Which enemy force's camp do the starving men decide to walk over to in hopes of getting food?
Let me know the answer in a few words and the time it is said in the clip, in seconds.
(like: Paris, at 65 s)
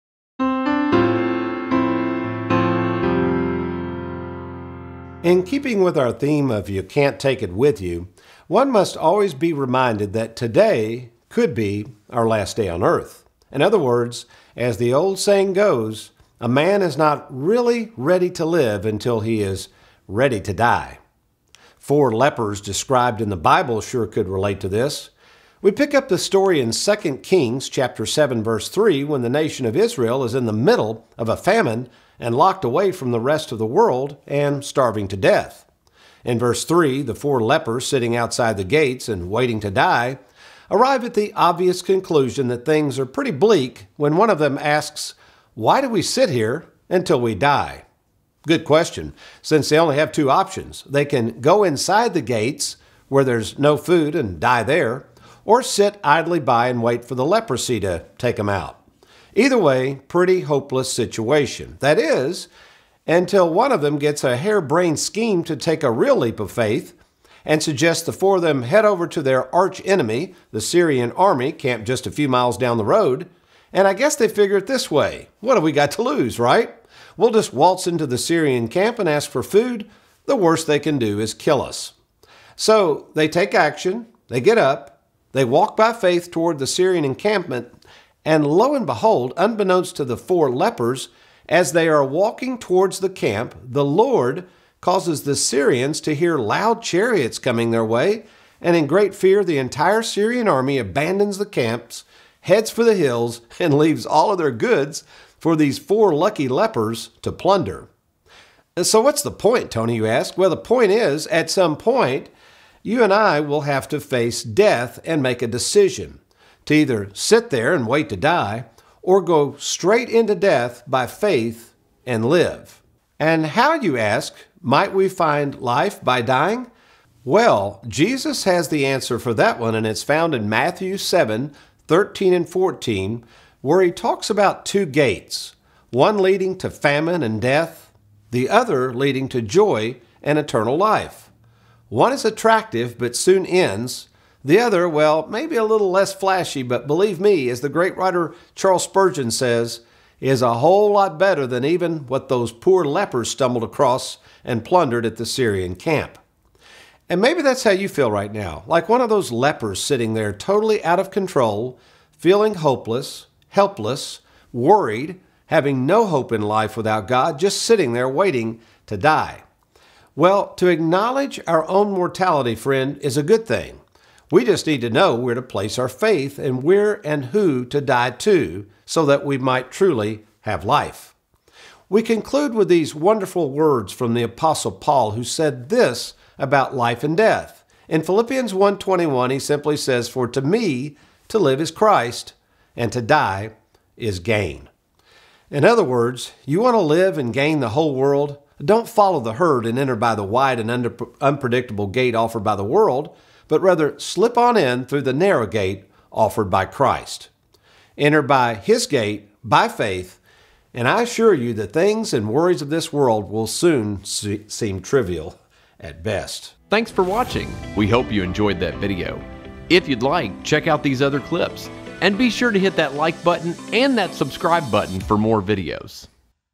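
the Syrian army, at 70 s.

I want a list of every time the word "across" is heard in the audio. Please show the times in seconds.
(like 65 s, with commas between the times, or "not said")
153 s.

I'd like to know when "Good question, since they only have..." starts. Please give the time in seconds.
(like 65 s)
48 s.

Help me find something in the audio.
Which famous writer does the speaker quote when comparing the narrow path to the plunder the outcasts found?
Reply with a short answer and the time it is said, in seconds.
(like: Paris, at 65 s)
Charles Spurgeon, at 148 s.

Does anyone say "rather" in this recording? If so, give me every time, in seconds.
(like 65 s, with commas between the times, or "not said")
203 s.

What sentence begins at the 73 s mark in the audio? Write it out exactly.
And I guess they figure it this way what have we got to lose, right?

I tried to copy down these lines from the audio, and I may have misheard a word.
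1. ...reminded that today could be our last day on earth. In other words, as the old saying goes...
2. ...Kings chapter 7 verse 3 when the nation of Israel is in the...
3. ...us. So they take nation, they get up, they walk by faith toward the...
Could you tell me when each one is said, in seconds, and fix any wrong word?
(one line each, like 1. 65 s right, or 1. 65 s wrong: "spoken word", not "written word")
1. 9 s right
2. 27 s right
3. 81 s wrong: "action", not "nation".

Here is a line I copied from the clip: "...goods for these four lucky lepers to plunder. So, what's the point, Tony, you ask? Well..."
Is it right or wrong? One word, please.
right.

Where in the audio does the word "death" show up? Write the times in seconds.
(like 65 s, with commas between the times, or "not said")
35 s, 114 s, 120 s, 137 s, 187 s.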